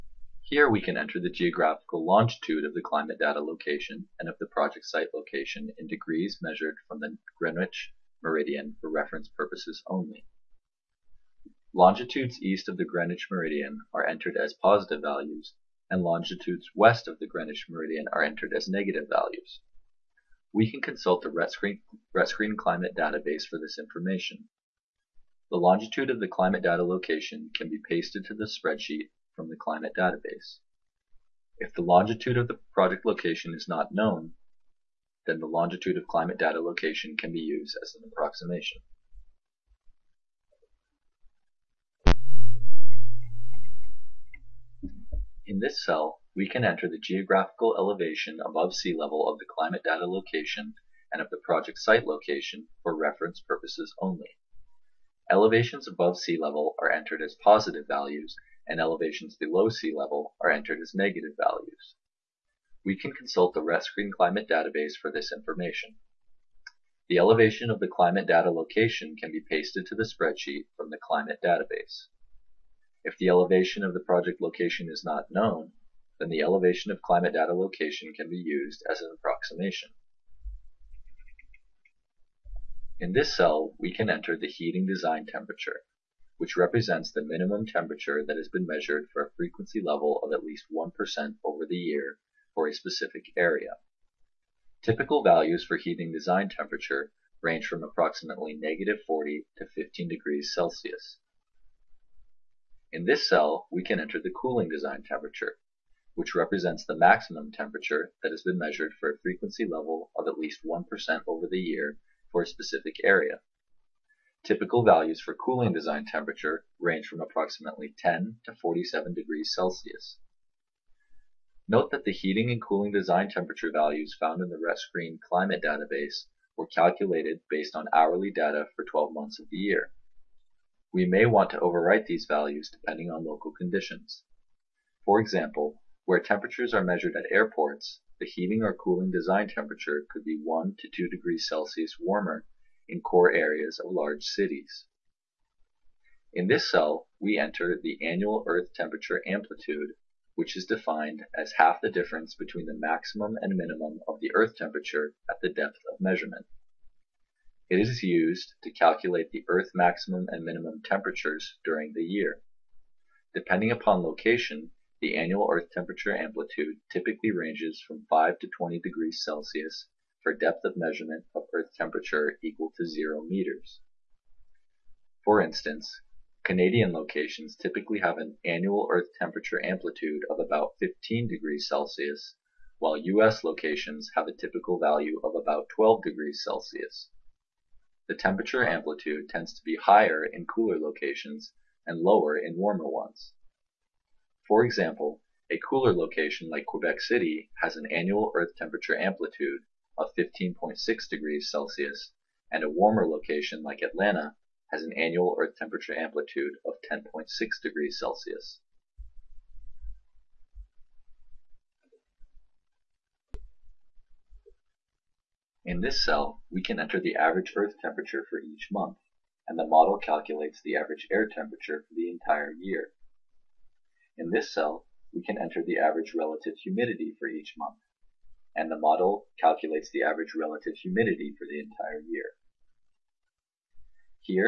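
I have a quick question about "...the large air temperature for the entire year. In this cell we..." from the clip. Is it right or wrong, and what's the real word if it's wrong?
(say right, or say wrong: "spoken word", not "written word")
wrong: "average", not "large".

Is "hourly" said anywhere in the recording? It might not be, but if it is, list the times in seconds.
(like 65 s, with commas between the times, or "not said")
127 s.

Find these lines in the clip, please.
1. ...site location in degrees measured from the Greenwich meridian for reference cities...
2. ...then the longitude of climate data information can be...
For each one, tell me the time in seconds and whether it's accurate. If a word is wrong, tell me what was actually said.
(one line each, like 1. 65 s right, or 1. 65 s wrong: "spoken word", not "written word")
1. 4 s wrong: "purposes", not "cities"
2. 35 s wrong: "location", not "information".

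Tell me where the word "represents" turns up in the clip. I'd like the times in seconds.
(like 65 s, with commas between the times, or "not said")
86 s, 106 s.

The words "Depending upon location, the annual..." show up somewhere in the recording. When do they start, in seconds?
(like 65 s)
163 s.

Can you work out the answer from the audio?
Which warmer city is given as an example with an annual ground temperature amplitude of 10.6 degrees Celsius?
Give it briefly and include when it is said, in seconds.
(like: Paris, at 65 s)
Atlanta, at 203 s.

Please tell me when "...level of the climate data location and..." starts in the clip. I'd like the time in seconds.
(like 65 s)
48 s.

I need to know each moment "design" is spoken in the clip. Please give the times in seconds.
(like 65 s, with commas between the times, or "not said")
84 s, 96 s, 104 s, 115 s, 122 s, 139 s.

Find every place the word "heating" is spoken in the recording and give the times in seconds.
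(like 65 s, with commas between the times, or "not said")
84 s, 95 s, 122 s, 138 s.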